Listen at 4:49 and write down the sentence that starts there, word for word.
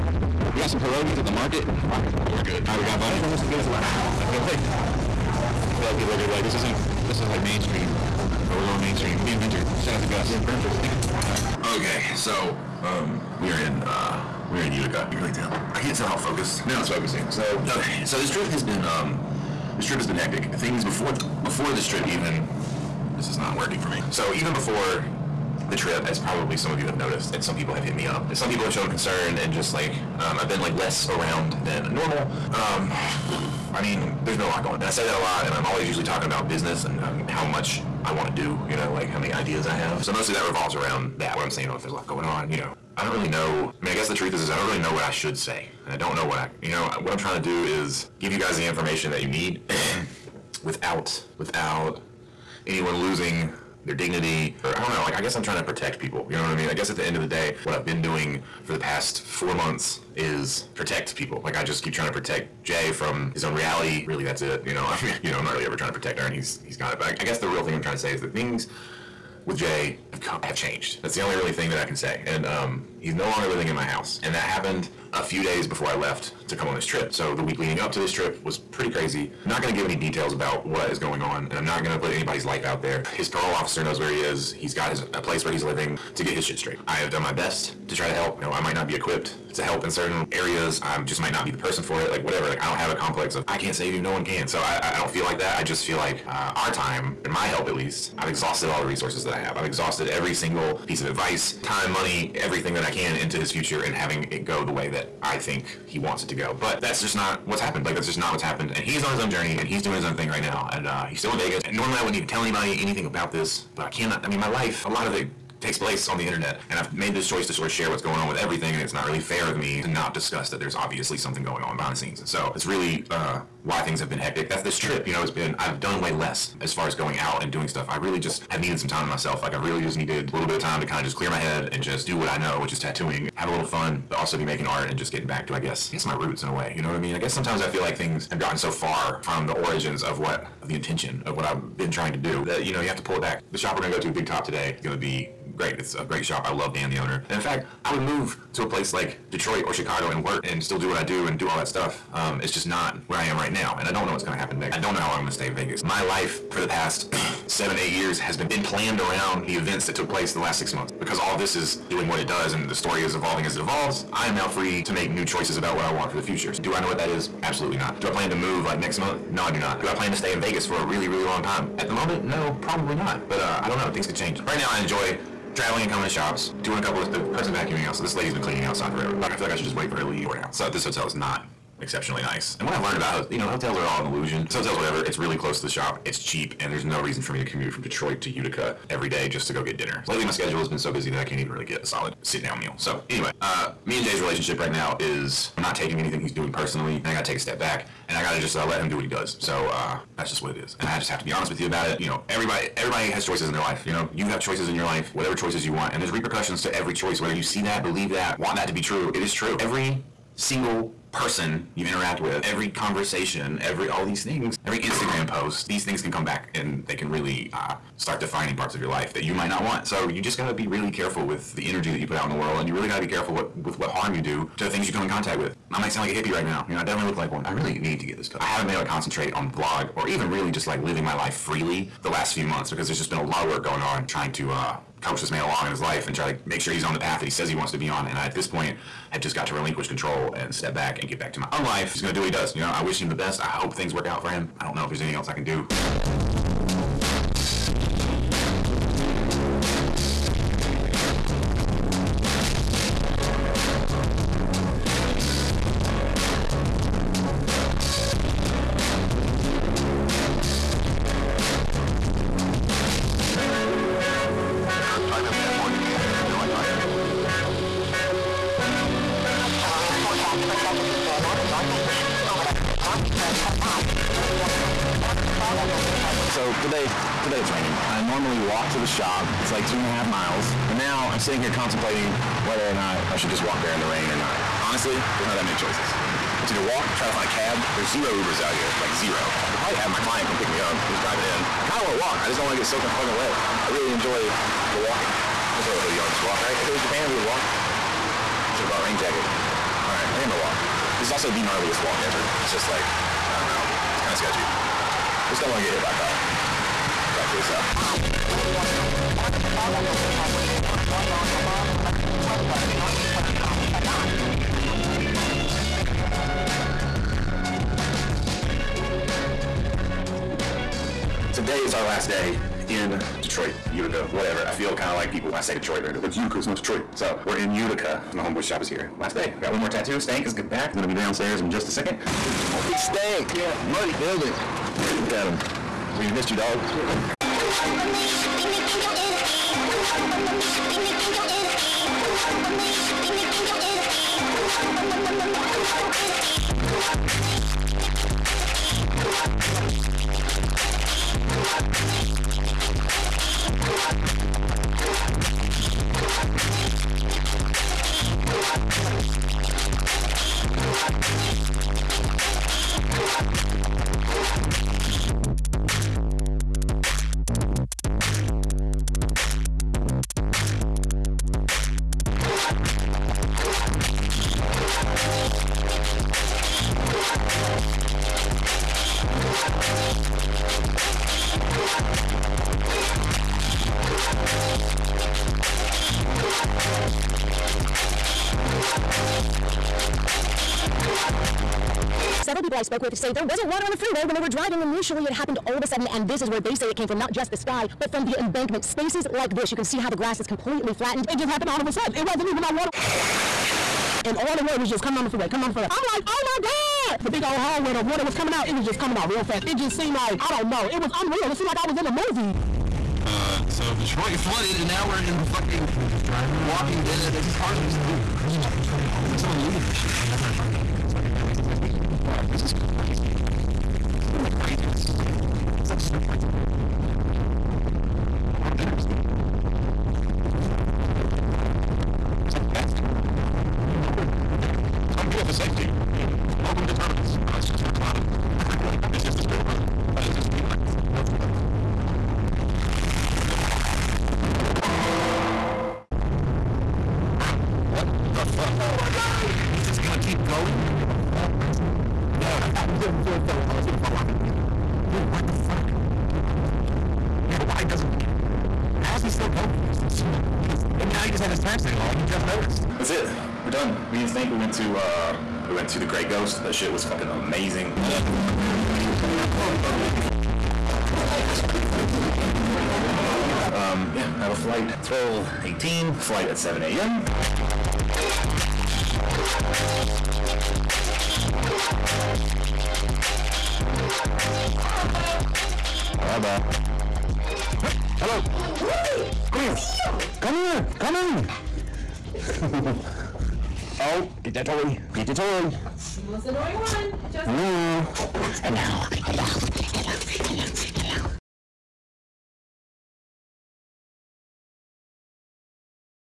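I could probably have my client come pick me up.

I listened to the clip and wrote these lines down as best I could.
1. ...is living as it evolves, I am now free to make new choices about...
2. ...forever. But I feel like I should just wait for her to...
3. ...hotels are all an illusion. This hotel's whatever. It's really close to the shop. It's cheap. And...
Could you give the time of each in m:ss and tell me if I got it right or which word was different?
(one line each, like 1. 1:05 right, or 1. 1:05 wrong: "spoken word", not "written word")
1. 2:43 wrong: "evolving", not "living"
2. 2:58 right
3. 3:03 right.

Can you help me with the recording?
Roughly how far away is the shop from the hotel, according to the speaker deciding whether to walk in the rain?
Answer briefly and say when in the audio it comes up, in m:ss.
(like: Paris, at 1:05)
two and a half miles, at 4:39.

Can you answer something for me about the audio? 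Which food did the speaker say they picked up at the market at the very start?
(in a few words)
pierogies.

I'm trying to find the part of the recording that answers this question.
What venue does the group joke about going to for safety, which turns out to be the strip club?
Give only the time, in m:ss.
7:16.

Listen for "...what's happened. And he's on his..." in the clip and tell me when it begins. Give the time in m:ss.
1:48.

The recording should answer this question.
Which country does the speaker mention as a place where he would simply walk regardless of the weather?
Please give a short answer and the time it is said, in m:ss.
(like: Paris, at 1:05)
Japan, at 4:56.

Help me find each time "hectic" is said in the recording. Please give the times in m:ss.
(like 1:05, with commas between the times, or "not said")
0:20, 2:04.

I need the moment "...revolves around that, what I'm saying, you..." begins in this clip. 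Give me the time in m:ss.
0:40.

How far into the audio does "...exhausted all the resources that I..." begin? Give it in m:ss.
1:38.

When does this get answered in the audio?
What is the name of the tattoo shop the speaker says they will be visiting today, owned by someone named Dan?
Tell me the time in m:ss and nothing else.
2:24.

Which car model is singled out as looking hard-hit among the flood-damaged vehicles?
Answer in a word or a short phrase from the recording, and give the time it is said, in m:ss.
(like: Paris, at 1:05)
Cadillac CTSV, at 7:01.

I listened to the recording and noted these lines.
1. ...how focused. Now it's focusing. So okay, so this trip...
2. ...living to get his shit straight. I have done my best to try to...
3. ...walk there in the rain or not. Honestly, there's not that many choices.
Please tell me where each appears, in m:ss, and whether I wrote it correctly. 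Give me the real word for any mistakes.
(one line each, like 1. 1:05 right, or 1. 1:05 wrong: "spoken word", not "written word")
1. 0:16 right
2. 1:25 right
3. 4:43 right.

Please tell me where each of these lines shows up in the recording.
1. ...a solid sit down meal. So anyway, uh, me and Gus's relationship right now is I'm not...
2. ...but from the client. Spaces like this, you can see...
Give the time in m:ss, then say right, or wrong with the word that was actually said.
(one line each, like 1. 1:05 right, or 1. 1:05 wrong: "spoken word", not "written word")
1. 3:11 wrong: "Jay", not "Gus"
2. 6:37 wrong: "embankment", not "client".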